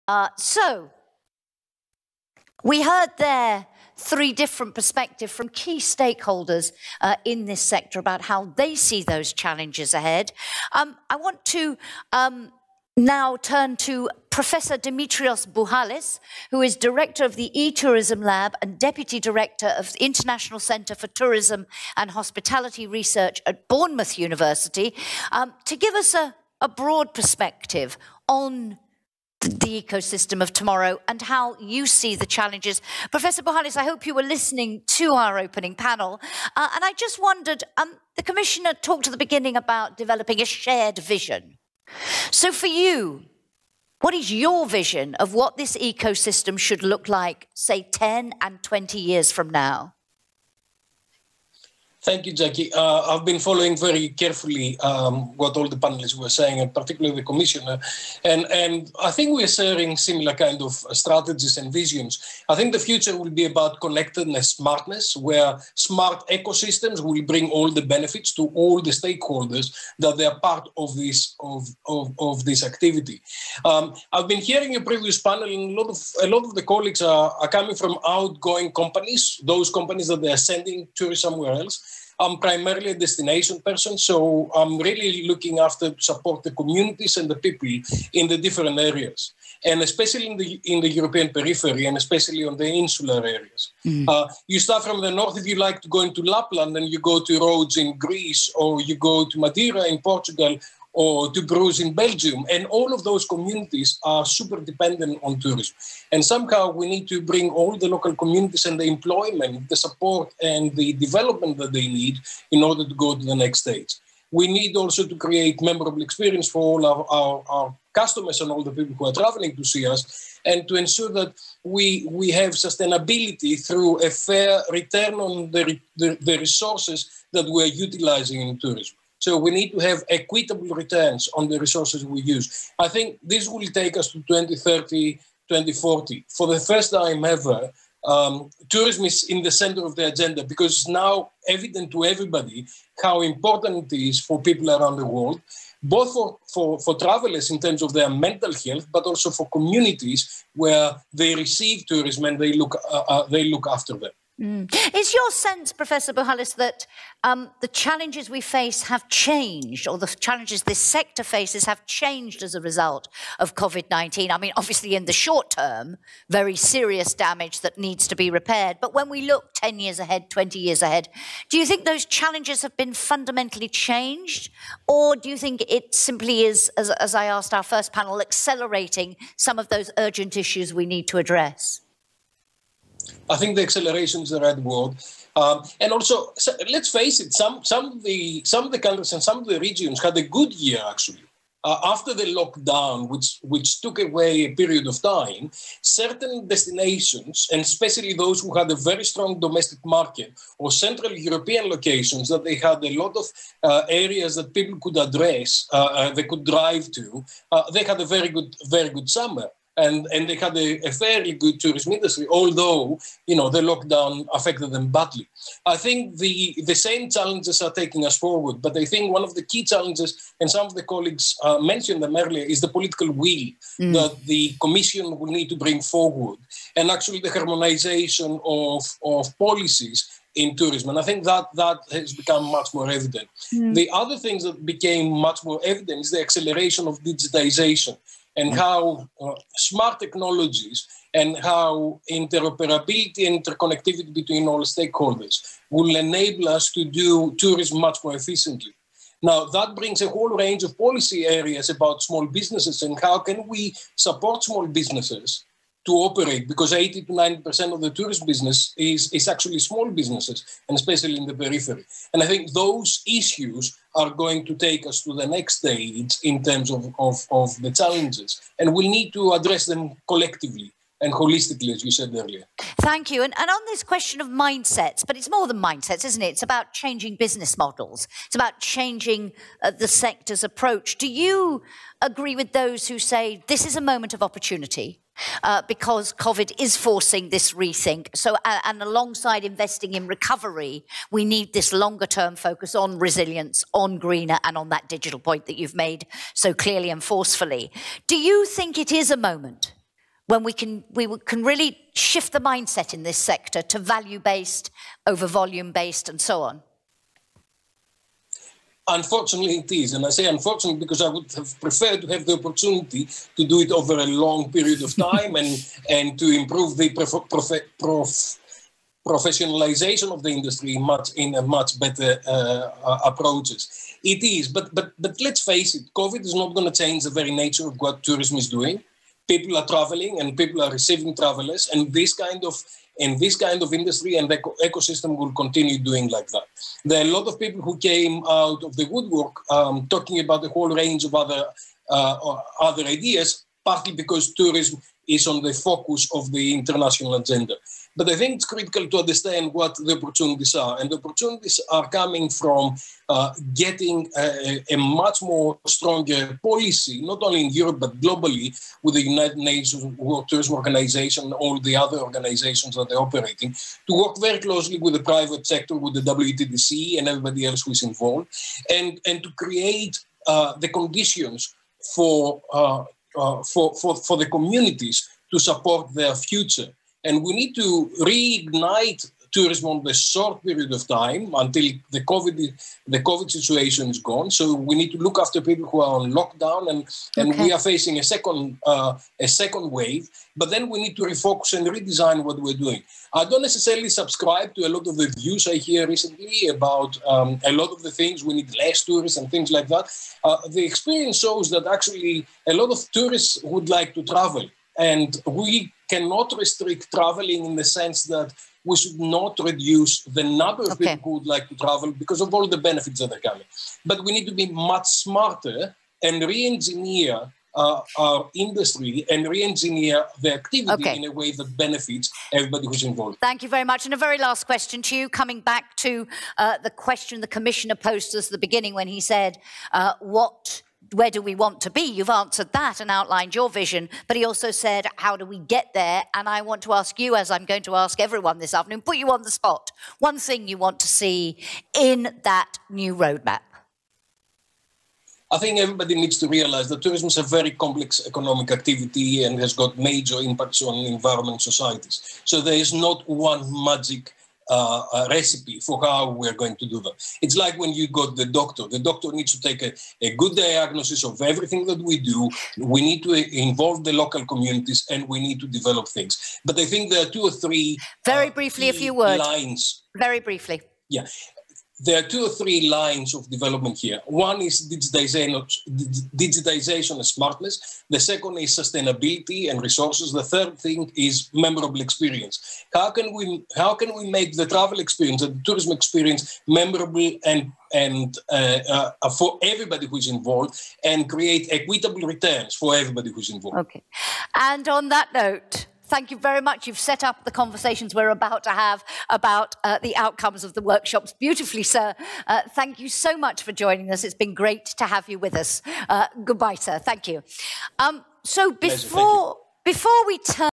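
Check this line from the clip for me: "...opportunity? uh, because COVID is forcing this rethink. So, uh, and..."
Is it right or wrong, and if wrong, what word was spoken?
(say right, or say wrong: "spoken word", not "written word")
right.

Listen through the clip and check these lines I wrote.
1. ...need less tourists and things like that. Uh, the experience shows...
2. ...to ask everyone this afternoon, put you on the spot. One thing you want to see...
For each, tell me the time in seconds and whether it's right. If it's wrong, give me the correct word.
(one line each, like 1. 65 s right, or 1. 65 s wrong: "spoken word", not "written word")
1. 398 s right
2. 437 s right.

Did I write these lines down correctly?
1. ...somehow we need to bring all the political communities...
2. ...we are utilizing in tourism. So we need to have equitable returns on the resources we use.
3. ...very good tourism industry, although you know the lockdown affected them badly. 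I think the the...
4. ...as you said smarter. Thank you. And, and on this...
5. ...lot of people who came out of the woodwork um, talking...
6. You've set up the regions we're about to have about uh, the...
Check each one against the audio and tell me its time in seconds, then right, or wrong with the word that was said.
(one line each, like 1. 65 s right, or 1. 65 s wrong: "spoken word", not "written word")
1. 106 s wrong: "local", not "political"
2. 127 s right
3. 210 s right
4. 271 s wrong: "earlier", not "smarter"
5. 337 s right
6. 496 s wrong: "conversations", not "regions".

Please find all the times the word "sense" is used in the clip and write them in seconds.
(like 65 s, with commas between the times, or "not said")
155 s, 407 s.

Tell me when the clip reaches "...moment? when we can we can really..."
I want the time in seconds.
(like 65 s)
299 s.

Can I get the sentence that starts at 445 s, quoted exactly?
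I think everybody needs to realize that tourism is a very complex economic activity and has got major impacts on environment societies.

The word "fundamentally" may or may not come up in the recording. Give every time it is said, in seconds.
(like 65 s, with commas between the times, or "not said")
172 s.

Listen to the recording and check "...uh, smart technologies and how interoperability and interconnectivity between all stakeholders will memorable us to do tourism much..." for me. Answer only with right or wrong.
wrong.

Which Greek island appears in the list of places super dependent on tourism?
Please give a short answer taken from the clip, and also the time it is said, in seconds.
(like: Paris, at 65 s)
Rhodes, at 97 s.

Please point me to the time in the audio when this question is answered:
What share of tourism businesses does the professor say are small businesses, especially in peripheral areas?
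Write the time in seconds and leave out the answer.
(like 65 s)
256 s.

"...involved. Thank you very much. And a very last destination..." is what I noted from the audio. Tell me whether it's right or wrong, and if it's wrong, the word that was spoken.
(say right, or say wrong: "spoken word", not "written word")
wrong: "question", not "destination".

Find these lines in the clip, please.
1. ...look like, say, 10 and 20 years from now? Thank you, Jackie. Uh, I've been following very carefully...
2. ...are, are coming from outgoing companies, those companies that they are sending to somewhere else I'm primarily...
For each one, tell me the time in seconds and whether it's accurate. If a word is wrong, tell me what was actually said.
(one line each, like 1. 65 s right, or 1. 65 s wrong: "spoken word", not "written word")
1. 46 s right
2. 77 s right.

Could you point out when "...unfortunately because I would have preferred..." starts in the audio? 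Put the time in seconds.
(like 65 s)
310 s.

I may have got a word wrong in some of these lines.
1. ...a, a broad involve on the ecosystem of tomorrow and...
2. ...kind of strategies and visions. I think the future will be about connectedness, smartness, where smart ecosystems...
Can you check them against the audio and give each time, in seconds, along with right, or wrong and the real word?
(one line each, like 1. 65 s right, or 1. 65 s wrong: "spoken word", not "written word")
1. 26 s wrong: "perspective", not "involve"
2. 60 s right.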